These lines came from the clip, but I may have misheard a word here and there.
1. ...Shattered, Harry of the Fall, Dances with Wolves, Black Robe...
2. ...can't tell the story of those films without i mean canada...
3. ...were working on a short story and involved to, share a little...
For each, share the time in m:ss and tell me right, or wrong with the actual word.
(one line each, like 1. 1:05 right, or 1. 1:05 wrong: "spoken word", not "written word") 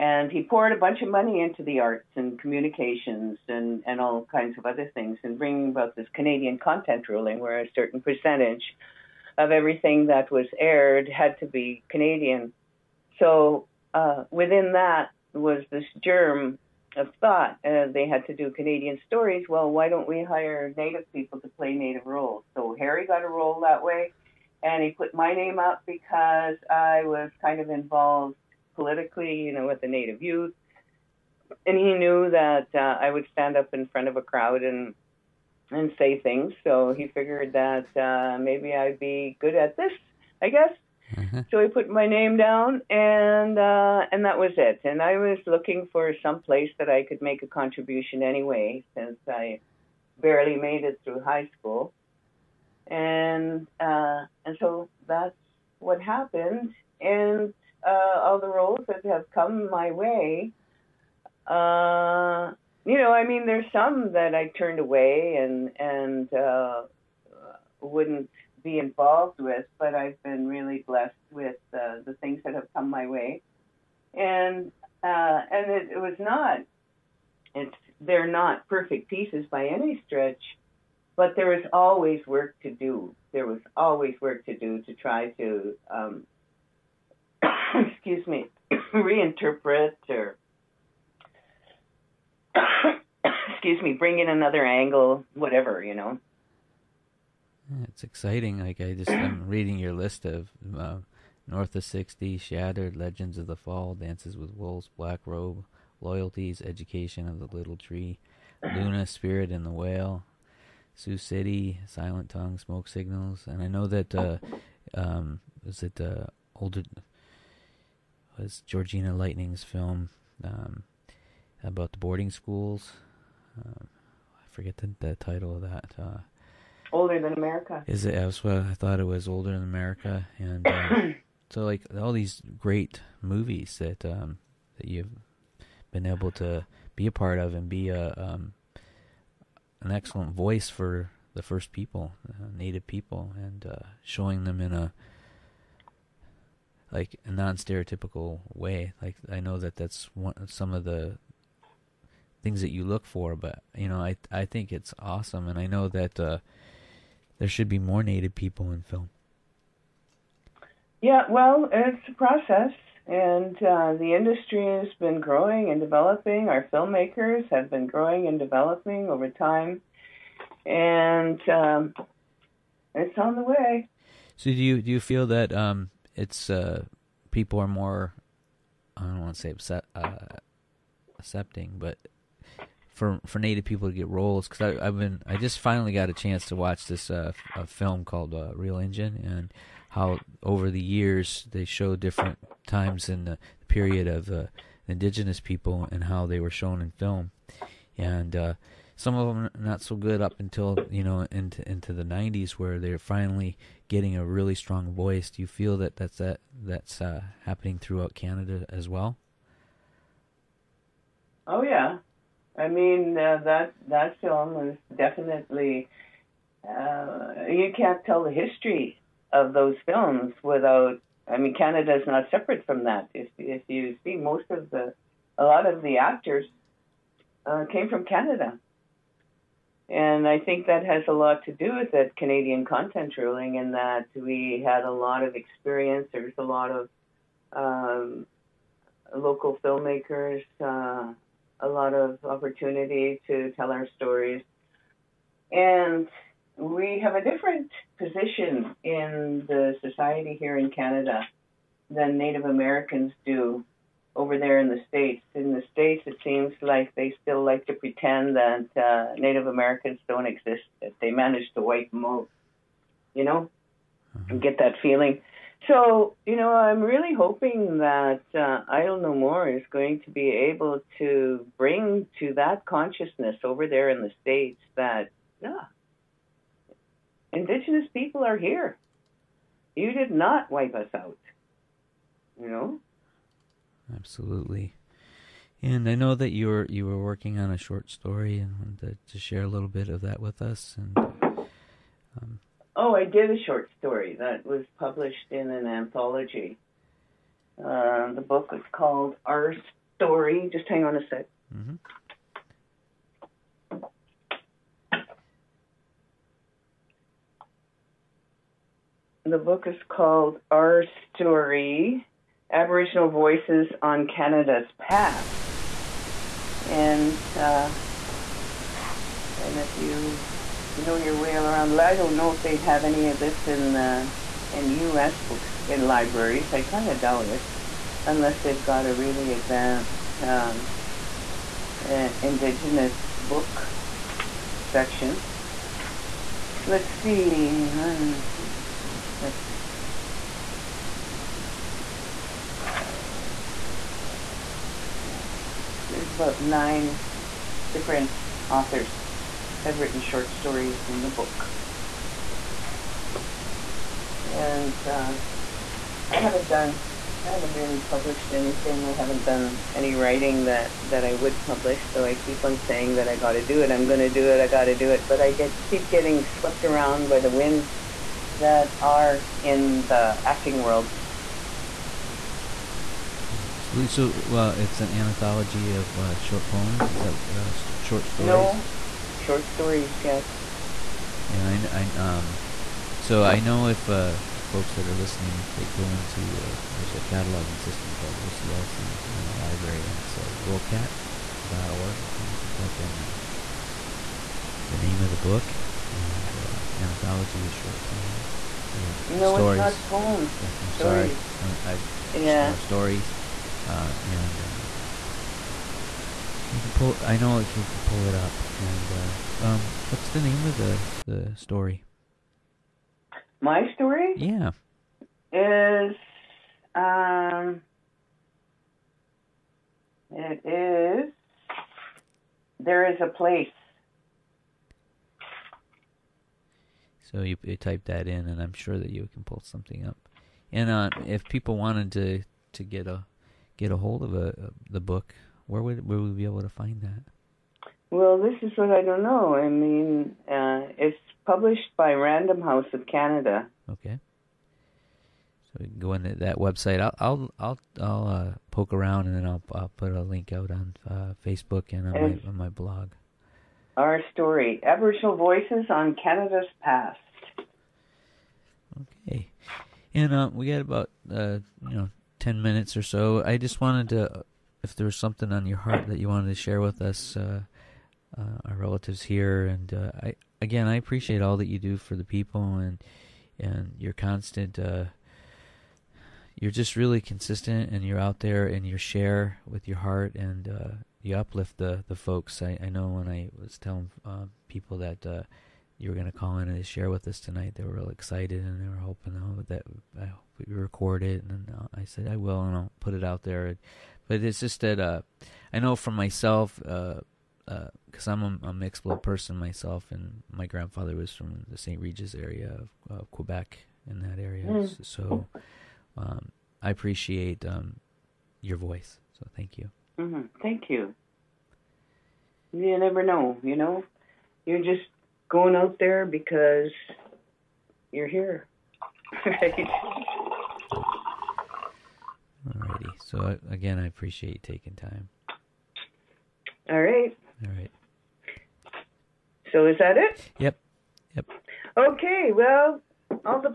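1. 1:42 wrong: "Legends", not "Harry"
2. 3:37 wrong: "history", not "story"
3. 4:46 wrong: "wanted", not "involved".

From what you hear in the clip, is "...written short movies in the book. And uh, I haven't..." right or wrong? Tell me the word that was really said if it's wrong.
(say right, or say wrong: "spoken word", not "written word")
wrong: "stories", not "movies".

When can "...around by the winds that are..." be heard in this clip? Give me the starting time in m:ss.
6:06.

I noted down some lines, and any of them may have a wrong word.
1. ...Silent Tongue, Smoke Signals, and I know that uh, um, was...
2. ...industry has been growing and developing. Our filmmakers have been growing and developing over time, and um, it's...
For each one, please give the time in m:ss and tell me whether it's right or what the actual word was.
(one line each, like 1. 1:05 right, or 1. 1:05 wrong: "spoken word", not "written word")
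1. 1:51 right
2. 2:44 right.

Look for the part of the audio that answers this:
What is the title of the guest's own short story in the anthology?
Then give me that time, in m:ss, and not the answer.
7:02.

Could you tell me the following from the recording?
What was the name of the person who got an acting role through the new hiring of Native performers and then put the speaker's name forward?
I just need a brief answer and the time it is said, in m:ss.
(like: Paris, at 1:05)
Harry, at 0:22.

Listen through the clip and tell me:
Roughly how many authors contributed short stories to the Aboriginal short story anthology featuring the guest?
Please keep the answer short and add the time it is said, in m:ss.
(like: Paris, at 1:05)
9, at 5:46.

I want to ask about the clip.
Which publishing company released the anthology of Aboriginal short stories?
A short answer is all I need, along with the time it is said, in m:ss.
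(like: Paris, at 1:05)
Random House of Canada, at 7:21.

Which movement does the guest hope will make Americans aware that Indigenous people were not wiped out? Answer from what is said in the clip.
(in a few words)
Idle No More.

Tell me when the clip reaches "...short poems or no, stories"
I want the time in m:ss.
6:37.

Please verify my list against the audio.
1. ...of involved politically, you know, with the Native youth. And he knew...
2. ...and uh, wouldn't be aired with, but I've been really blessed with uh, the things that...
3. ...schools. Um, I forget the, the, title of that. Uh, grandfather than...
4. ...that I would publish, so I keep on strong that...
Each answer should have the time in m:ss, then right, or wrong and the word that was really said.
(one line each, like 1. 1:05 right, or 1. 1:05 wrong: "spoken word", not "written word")
1. 0:27 right
2. 1:05 wrong: "involved", not "aired"
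3. 2:02 wrong: "older", not "grandfather"
4. 6:00 wrong: "saying", not "strong".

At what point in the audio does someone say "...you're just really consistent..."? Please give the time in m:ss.
7:56.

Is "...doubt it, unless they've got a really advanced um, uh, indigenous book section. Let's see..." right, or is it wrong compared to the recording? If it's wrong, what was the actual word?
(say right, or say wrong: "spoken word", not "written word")
right.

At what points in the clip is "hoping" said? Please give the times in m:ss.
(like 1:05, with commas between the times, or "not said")
4:27, 8:08.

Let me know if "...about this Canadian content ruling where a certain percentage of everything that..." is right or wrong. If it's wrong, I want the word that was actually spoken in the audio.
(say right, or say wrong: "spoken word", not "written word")
right.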